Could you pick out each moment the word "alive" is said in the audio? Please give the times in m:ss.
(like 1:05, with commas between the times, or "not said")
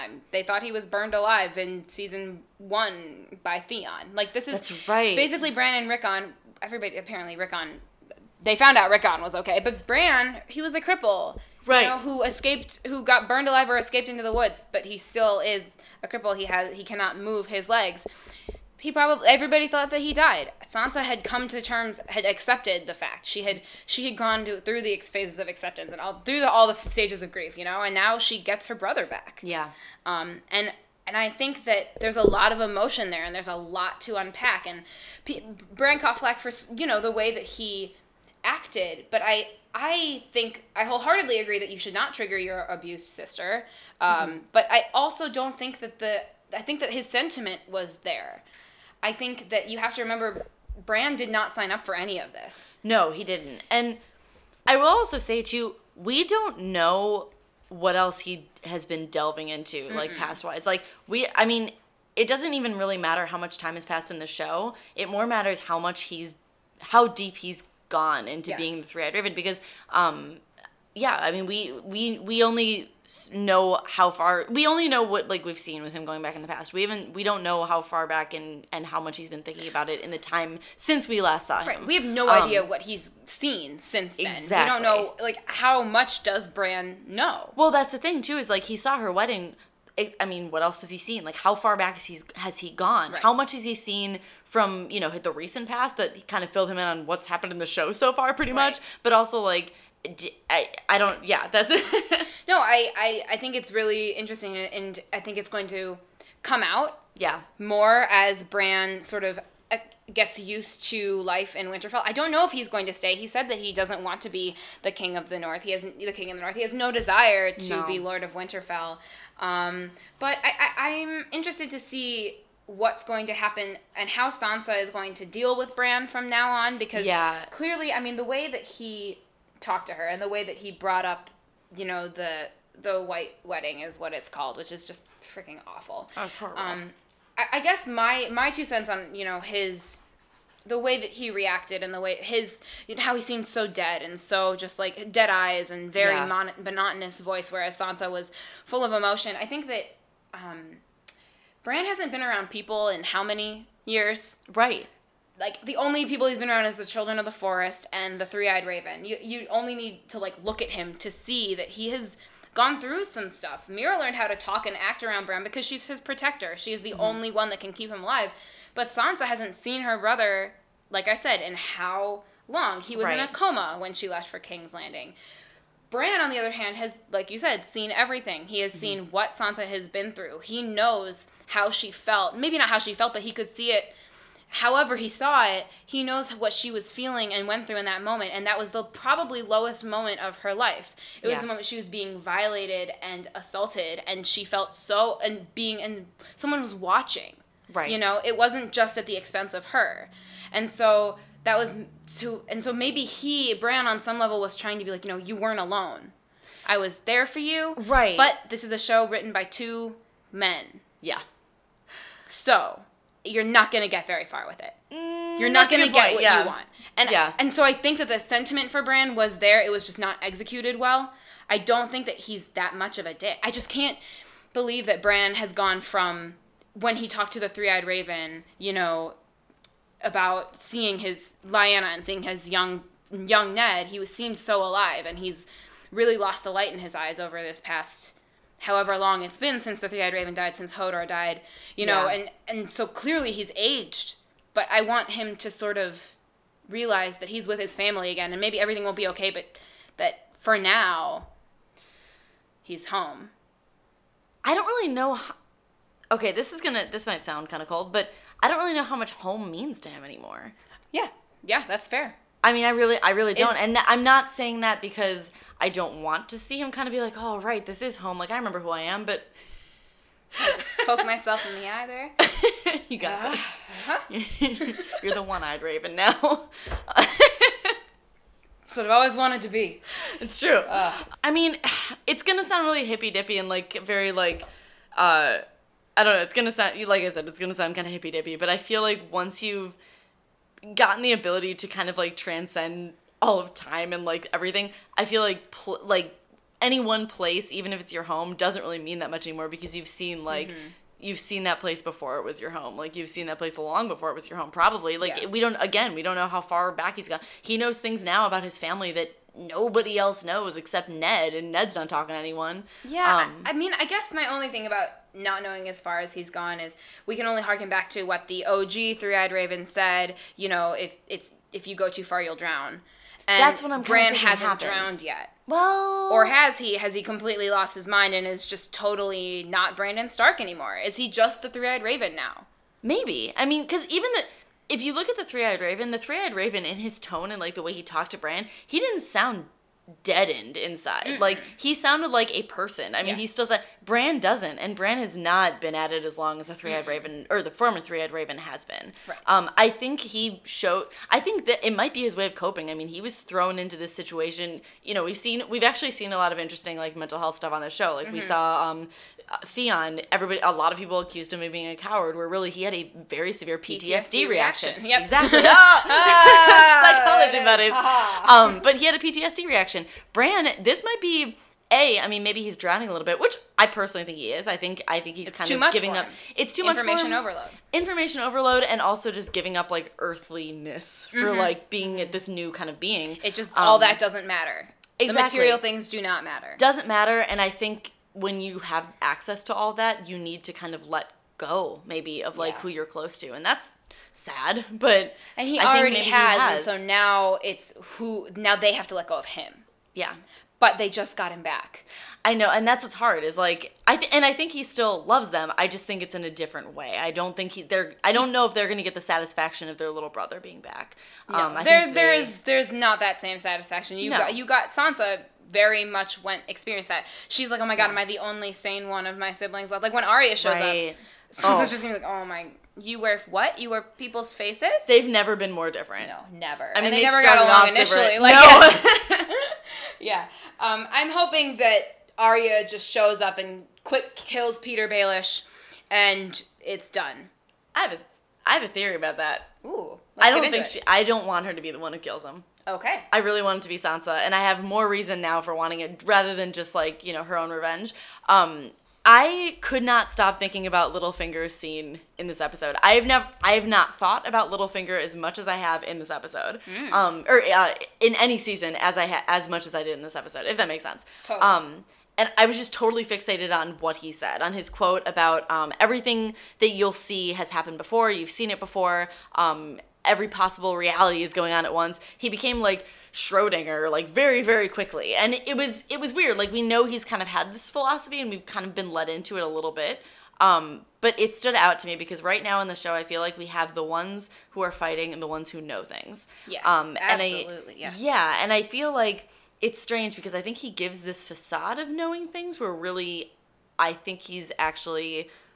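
0:01, 0:13, 2:48, 3:54.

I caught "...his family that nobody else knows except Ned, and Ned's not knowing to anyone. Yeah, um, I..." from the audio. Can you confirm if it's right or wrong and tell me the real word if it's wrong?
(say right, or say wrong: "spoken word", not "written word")
wrong: "talking", not "knowing".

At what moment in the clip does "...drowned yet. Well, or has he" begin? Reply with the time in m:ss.
5:24.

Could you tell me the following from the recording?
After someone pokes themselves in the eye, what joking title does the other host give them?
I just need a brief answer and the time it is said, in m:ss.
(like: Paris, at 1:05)
The one-eyed raven, at 4:35.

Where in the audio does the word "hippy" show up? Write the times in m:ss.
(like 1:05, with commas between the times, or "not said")
4:42, 4:47.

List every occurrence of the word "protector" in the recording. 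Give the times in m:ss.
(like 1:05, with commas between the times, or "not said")
2:45.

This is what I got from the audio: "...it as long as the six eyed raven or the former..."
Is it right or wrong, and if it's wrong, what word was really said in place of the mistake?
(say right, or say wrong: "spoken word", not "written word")
wrong: "three", not "six".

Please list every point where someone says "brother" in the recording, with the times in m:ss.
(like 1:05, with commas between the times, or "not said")
0:28, 2:49, 6:50.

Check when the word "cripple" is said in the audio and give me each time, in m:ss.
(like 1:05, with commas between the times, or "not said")
0:10, 0:16.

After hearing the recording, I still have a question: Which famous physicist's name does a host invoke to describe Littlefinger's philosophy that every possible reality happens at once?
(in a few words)
Schrodinger.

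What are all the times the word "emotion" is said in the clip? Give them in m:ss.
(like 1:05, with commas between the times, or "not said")
0:32, 2:28.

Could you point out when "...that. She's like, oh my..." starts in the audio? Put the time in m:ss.
6:56.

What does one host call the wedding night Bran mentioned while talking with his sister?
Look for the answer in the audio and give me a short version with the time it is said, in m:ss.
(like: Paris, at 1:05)
The white wedding, at 2:12.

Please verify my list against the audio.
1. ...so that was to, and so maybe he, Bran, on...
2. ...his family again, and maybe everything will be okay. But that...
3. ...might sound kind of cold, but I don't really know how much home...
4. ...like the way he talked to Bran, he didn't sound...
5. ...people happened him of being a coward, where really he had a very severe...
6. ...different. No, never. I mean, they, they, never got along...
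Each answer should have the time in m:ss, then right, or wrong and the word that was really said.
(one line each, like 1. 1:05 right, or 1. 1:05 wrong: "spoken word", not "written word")
1. 3:20 right
2. 4:07 right
3. 4:17 right
4. 5:37 right
5. 6:00 wrong: "accused", not "happened"
6. 7:05 right.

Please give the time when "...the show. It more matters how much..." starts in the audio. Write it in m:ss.
1:04.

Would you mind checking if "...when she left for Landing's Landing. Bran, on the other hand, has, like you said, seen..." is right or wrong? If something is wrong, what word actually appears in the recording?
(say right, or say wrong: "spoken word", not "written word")
wrong: "King", not "Landing".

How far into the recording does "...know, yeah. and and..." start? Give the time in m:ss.
4:01.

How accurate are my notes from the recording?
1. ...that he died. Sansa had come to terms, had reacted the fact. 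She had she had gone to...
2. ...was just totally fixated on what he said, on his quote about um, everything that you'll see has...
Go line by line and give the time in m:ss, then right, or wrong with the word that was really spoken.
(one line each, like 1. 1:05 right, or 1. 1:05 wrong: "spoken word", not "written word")
1. 0:19 wrong: "accepted", not "reacted"
2. 7:42 right.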